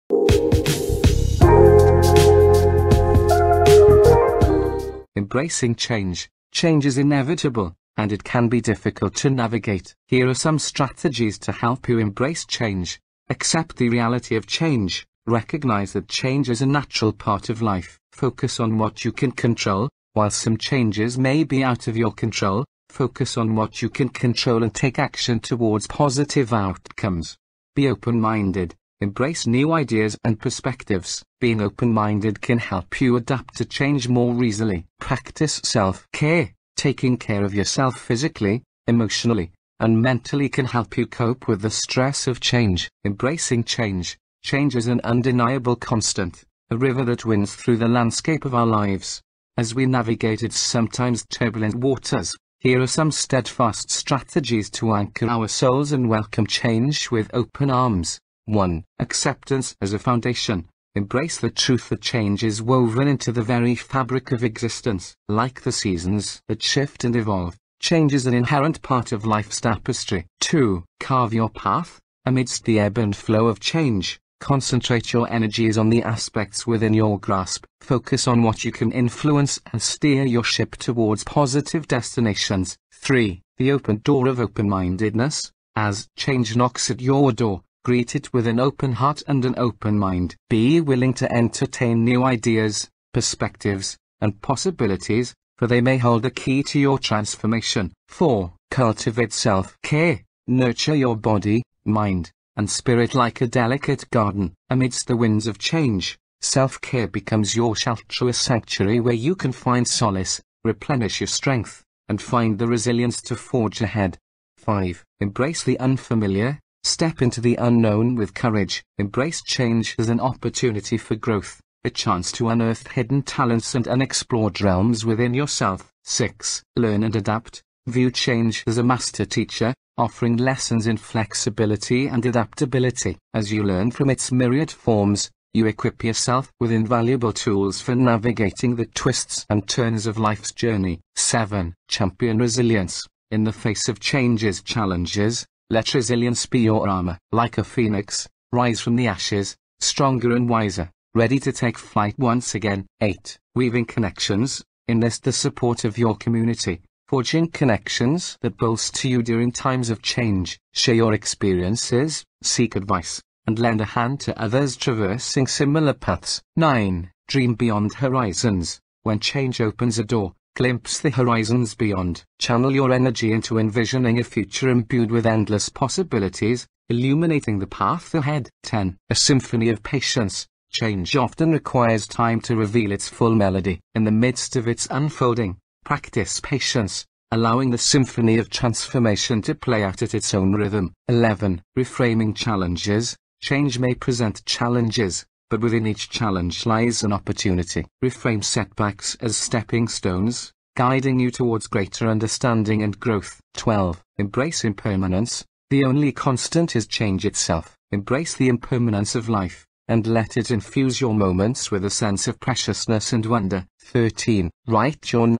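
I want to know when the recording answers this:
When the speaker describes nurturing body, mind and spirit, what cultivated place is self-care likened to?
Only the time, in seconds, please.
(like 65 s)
103 s.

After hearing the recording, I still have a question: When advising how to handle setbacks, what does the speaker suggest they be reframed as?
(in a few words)
Stepping stones.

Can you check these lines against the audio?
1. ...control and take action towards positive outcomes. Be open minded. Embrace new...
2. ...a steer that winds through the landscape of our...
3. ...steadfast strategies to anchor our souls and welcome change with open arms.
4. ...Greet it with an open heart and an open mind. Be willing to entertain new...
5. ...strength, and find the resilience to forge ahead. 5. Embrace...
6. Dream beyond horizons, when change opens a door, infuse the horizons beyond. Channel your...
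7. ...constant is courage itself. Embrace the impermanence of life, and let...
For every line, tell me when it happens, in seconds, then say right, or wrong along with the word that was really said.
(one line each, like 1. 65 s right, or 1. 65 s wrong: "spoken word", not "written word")
1. 24 s right
2. 46 s wrong: "river", not "steer"
3. 53 s right
4. 87 s right
5. 111 s right
6. 167 s wrong: "glimpse", not "infuse"
7. 206 s wrong: "change", not "courage".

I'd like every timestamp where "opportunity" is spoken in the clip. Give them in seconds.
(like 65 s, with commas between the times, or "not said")
120 s, 197 s.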